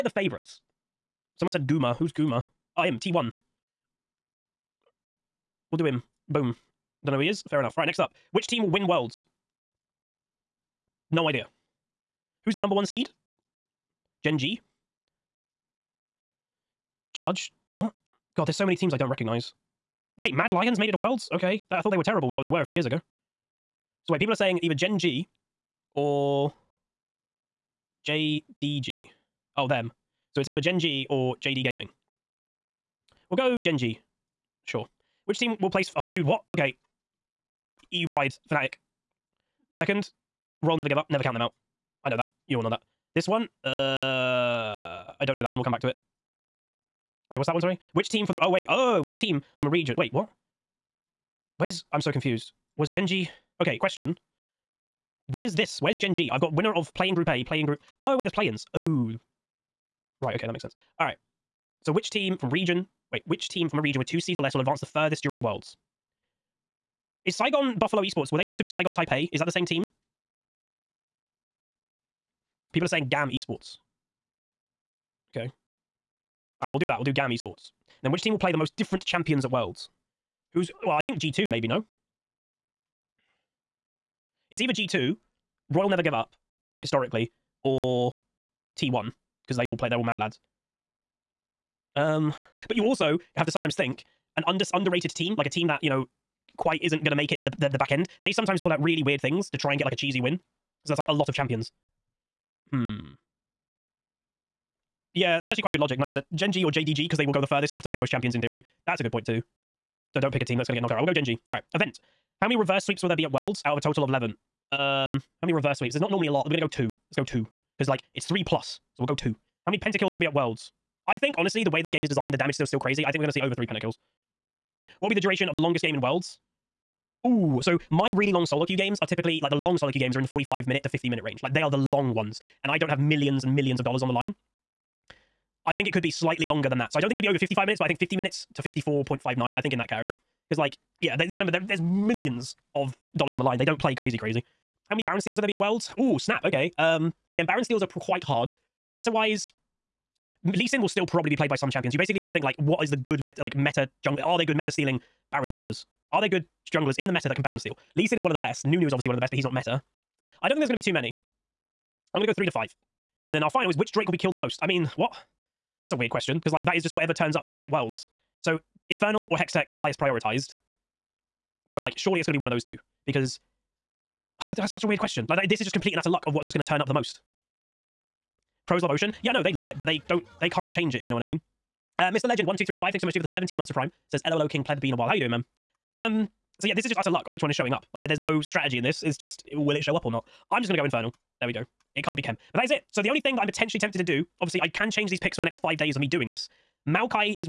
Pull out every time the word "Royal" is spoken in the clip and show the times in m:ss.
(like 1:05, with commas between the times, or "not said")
0:40, 1:25.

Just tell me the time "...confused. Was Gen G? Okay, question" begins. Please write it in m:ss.
0:52.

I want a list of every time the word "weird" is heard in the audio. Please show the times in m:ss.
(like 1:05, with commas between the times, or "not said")
1:39, 2:45, 2:54.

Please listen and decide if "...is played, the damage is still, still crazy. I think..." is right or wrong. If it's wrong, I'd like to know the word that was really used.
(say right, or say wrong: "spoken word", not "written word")
wrong: "designed", not "played".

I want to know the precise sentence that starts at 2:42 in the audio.
I'm going to go three to five.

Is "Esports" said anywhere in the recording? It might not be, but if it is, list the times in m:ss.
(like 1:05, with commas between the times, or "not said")
1:08, 1:13, 1:17.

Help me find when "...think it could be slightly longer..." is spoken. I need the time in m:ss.
2:15.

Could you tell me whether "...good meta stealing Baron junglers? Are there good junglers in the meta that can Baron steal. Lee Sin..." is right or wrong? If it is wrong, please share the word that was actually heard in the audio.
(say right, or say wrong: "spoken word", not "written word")
right.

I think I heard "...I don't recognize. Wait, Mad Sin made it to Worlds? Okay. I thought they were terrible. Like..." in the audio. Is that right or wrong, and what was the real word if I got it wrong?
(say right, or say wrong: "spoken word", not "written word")
wrong: "Lions", not "Sin".